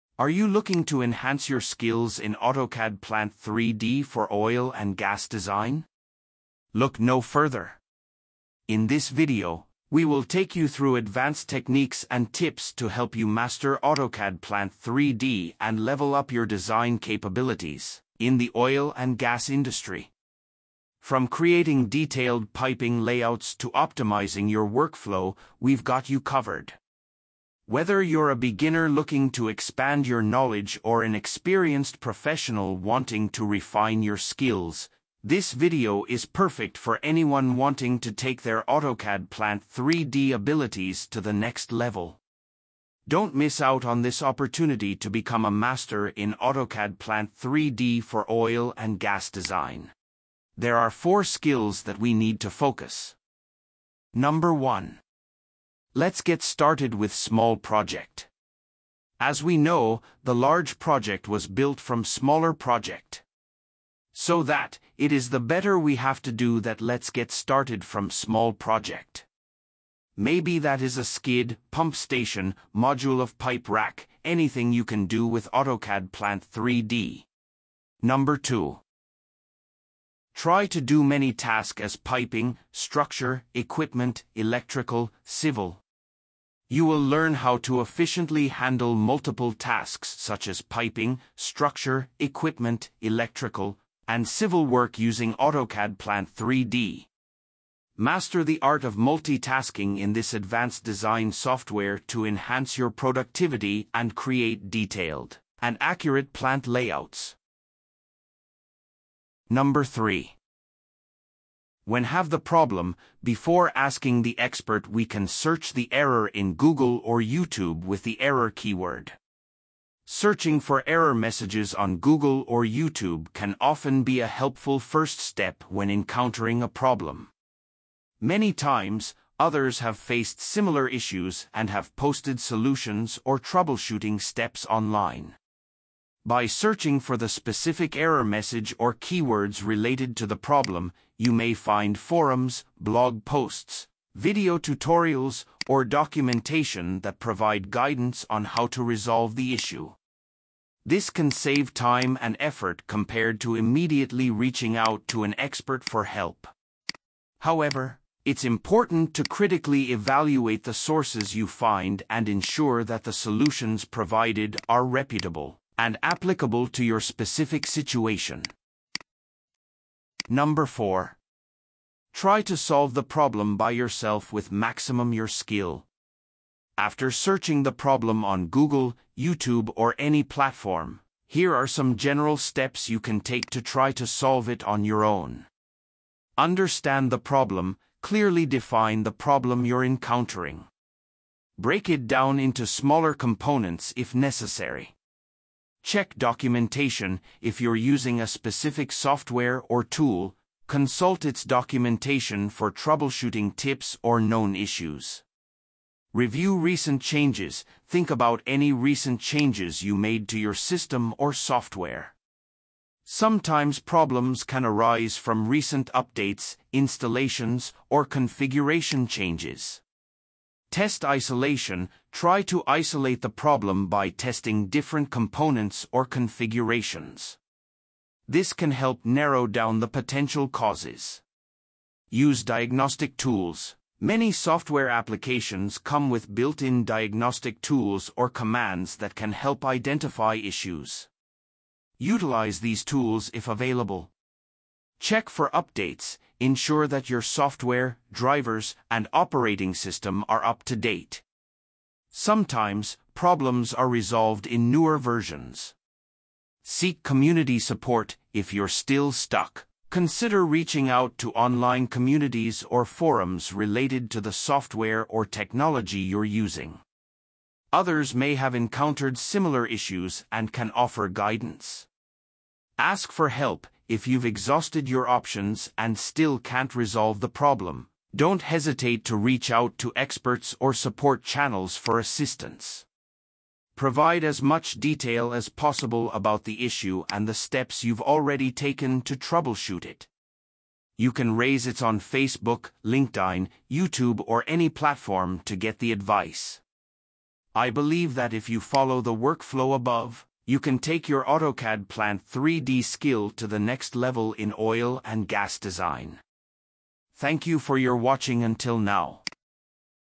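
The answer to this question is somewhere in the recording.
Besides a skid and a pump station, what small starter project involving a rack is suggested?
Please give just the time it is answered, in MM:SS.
01:12.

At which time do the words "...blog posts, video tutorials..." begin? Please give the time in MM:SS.
02:22.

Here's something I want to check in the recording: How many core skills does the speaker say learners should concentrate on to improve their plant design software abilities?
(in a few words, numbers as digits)
4.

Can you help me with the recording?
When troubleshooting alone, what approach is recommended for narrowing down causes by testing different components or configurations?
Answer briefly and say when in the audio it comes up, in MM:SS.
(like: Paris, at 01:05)
Test isolation, at 03:40.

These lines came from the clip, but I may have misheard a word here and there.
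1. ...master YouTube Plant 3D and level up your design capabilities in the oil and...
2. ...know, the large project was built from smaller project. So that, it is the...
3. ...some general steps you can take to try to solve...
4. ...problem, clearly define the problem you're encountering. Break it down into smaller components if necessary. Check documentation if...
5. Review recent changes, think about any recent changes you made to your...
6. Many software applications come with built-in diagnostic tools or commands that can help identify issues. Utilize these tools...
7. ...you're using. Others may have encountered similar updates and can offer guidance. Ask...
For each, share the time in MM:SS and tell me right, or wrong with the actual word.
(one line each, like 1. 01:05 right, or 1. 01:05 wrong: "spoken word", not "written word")
1. 00:13 wrong: "AutoCAD", not "YouTube"
2. 00:59 right
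3. 03:01 right
4. 03:07 right
5. 03:26 right
6. 03:53 right
7. 04:25 wrong: "issues", not "updates".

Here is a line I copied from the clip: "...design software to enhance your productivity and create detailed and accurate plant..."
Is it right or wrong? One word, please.
right.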